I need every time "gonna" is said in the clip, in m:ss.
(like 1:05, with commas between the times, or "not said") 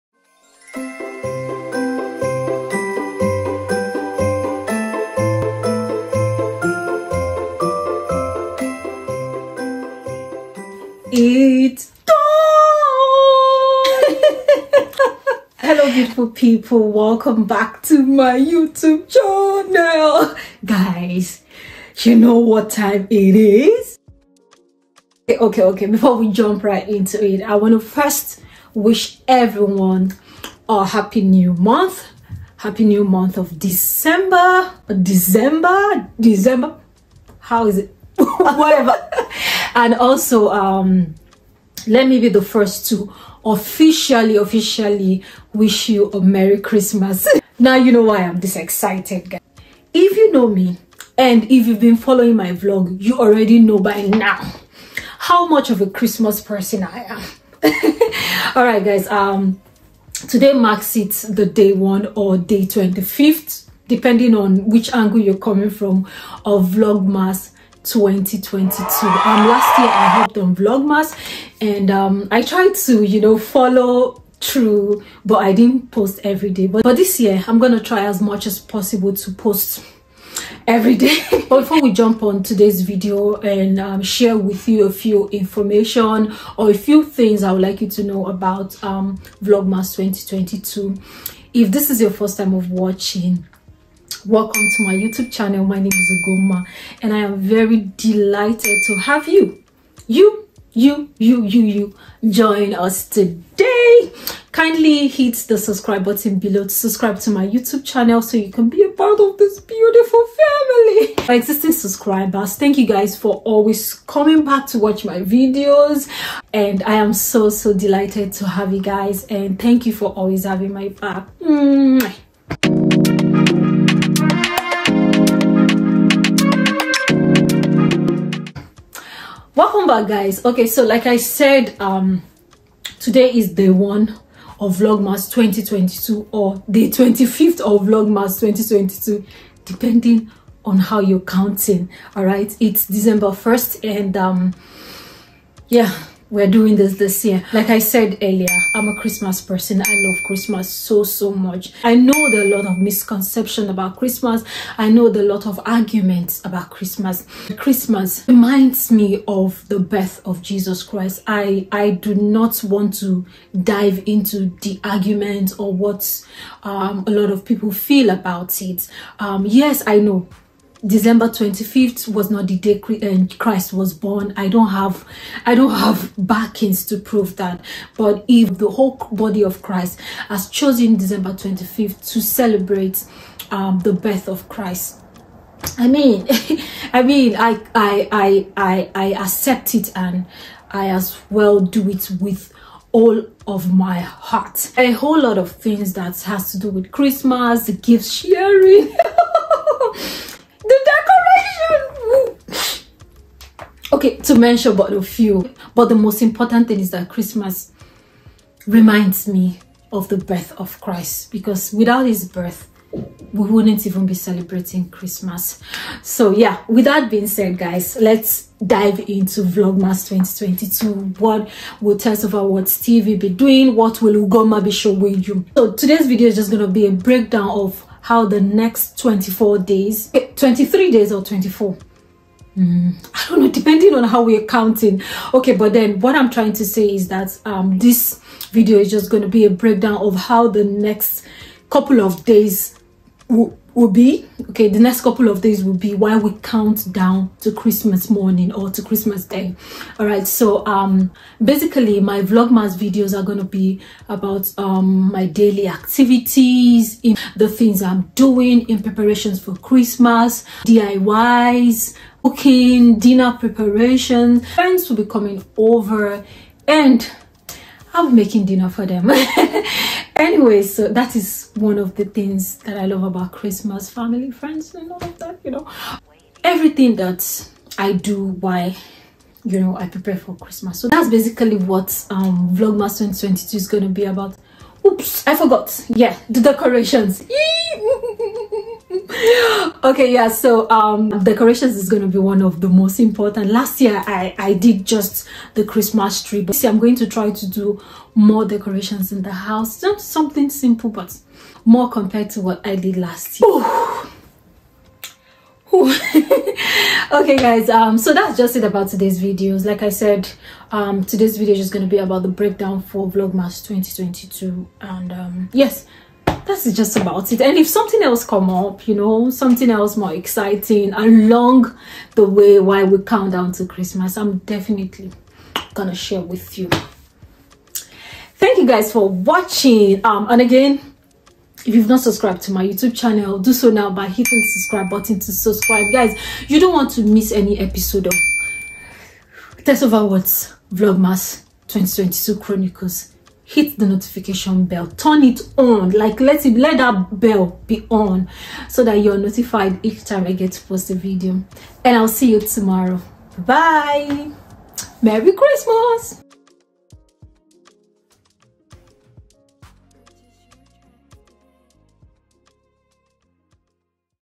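1:17, 5:25.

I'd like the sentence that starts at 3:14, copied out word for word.
A whole lot of things that has to do with Christmas, gift sharing.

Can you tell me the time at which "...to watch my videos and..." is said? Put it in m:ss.
1:54.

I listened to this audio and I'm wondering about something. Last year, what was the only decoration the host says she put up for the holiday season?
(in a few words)
Christmas tree.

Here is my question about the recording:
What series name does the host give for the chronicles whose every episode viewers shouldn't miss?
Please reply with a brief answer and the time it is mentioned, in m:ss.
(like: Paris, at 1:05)
TessOverWords, at 5:39.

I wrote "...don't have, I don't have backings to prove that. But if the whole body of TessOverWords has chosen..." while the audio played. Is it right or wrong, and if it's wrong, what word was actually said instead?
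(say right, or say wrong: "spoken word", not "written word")
wrong: "Christ", not "TessOverWords".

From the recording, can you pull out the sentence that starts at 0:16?
Welcome back to my YouTube channel.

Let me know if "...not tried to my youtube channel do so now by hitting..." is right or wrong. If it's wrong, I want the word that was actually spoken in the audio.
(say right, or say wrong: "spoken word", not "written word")
wrong: "subscribed", not "tried".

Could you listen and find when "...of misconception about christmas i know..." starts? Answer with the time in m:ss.
2:32.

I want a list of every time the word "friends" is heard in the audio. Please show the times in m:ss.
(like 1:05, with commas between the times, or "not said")
4:24, 4:34.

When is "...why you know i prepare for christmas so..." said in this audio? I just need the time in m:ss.
4:38.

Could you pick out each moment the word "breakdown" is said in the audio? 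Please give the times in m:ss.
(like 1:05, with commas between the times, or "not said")
3:46, 3:59, 5:12.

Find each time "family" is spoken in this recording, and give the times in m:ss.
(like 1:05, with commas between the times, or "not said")
1:50, 4:33.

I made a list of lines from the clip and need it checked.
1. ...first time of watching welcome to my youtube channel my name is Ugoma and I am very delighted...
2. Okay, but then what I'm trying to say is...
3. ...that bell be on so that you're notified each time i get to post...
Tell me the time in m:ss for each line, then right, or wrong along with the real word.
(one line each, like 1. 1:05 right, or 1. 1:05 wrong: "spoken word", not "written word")
1. 1:32 right
2. 3:55 right
3. 5:46 right.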